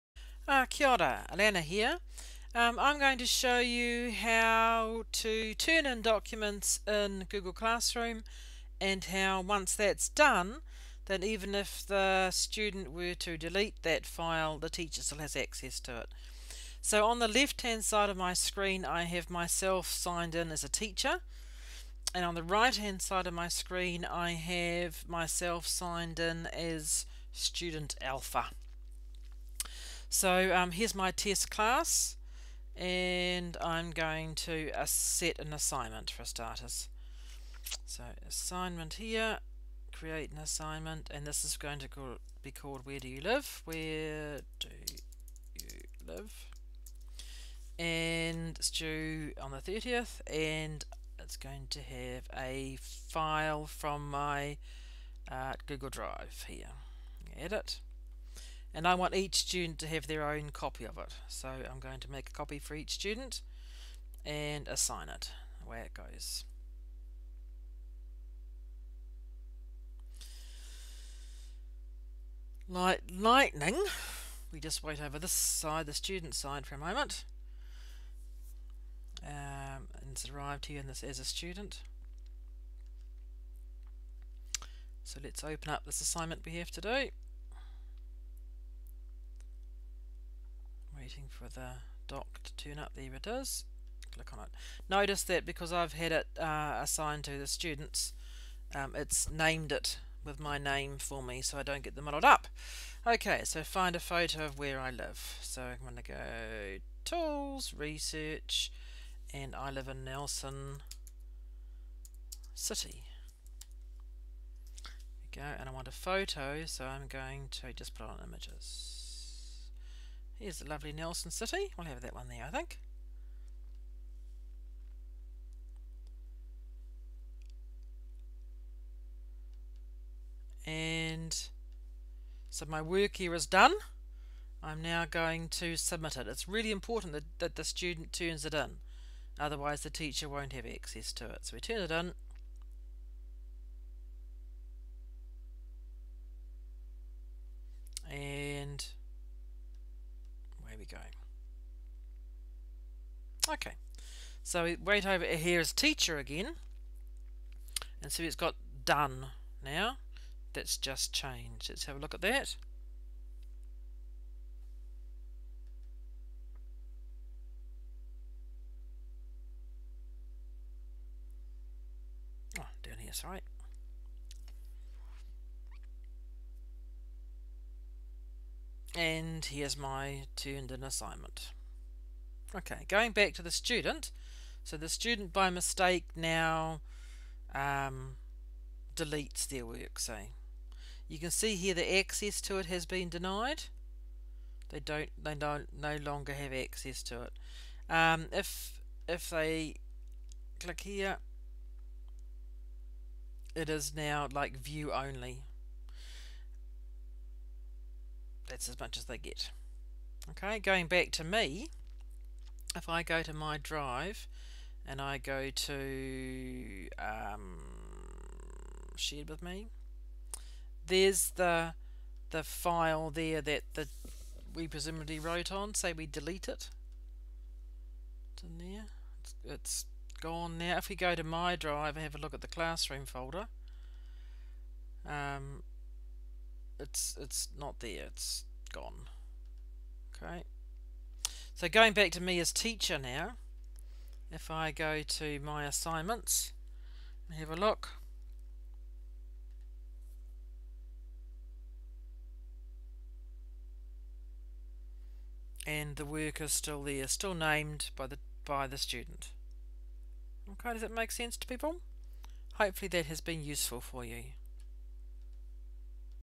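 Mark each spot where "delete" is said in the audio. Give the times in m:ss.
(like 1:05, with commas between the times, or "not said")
0:13, 3:08, 3:46.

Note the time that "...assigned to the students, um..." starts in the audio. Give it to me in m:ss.
1:36.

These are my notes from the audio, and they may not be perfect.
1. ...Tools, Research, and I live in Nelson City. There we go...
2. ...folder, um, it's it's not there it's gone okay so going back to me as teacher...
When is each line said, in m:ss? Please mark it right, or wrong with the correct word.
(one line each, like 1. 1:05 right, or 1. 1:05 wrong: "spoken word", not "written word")
1. 1:47 right
2. 3:53 right.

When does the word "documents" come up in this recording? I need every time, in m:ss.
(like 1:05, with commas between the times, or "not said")
0:06.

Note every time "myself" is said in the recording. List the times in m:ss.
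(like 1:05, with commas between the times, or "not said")
0:19, 0:25.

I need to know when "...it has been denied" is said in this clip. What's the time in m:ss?
3:12.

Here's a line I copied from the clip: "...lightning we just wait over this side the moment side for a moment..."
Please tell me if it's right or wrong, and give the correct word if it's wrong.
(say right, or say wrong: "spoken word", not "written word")
wrong: "student", not "moment".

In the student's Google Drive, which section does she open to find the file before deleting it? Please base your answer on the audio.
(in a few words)
Shared with me.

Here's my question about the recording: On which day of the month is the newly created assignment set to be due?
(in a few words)
30th.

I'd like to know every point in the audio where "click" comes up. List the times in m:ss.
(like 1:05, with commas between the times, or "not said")
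1:34, 3:20.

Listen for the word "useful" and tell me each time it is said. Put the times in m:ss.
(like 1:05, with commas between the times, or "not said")
4:23.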